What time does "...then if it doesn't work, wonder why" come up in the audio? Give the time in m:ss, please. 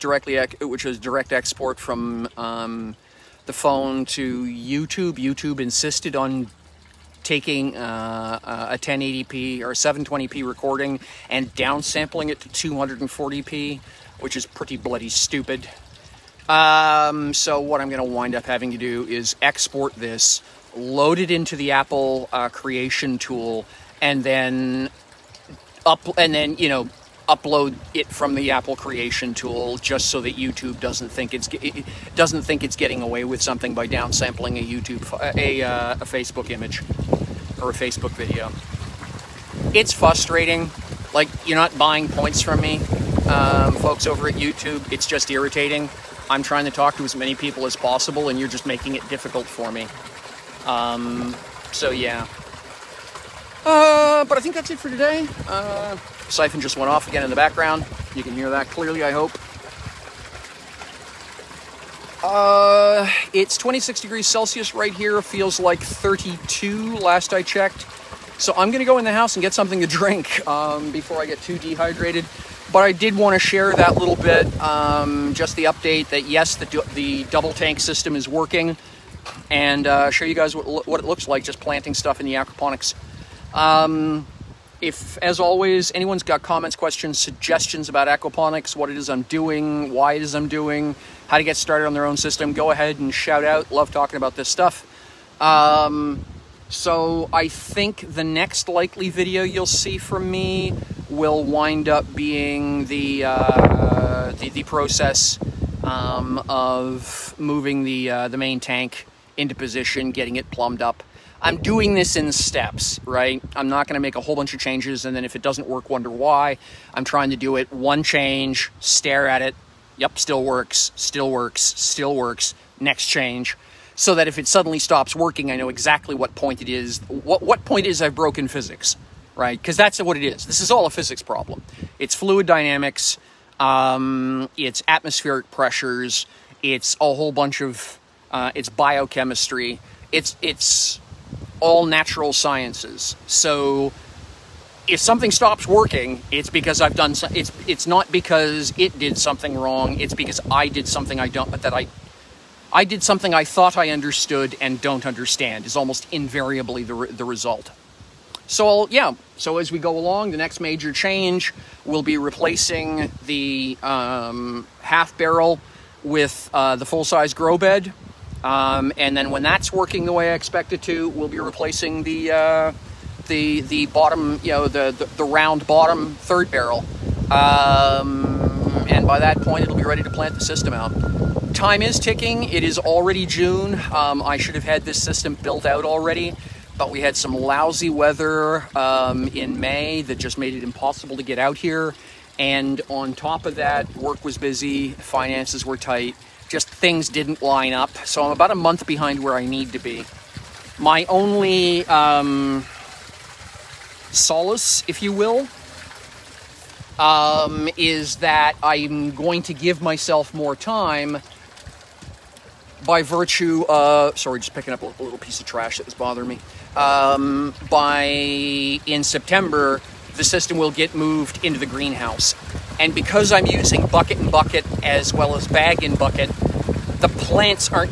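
1:55.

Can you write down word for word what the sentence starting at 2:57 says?
Um, and by that point, it'll be ready to plant the system out.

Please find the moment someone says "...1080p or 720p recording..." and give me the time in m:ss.
0:08.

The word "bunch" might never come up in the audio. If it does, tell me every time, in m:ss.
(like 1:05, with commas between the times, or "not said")
1:54, 2:17.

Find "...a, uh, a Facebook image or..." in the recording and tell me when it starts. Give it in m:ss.
0:35.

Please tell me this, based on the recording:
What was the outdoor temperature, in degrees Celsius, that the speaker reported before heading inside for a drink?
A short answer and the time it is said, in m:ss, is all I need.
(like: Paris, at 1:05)
26, at 1:03.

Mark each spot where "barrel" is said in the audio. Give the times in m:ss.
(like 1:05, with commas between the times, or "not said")
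2:45, 2:56.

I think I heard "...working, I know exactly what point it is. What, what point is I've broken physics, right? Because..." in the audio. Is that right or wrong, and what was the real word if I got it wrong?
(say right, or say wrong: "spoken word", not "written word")
right.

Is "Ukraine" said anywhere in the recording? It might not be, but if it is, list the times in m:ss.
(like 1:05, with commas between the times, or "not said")
not said.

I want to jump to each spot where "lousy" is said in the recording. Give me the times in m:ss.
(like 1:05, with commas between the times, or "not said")
3:07.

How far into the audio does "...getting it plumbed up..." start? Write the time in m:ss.
1:50.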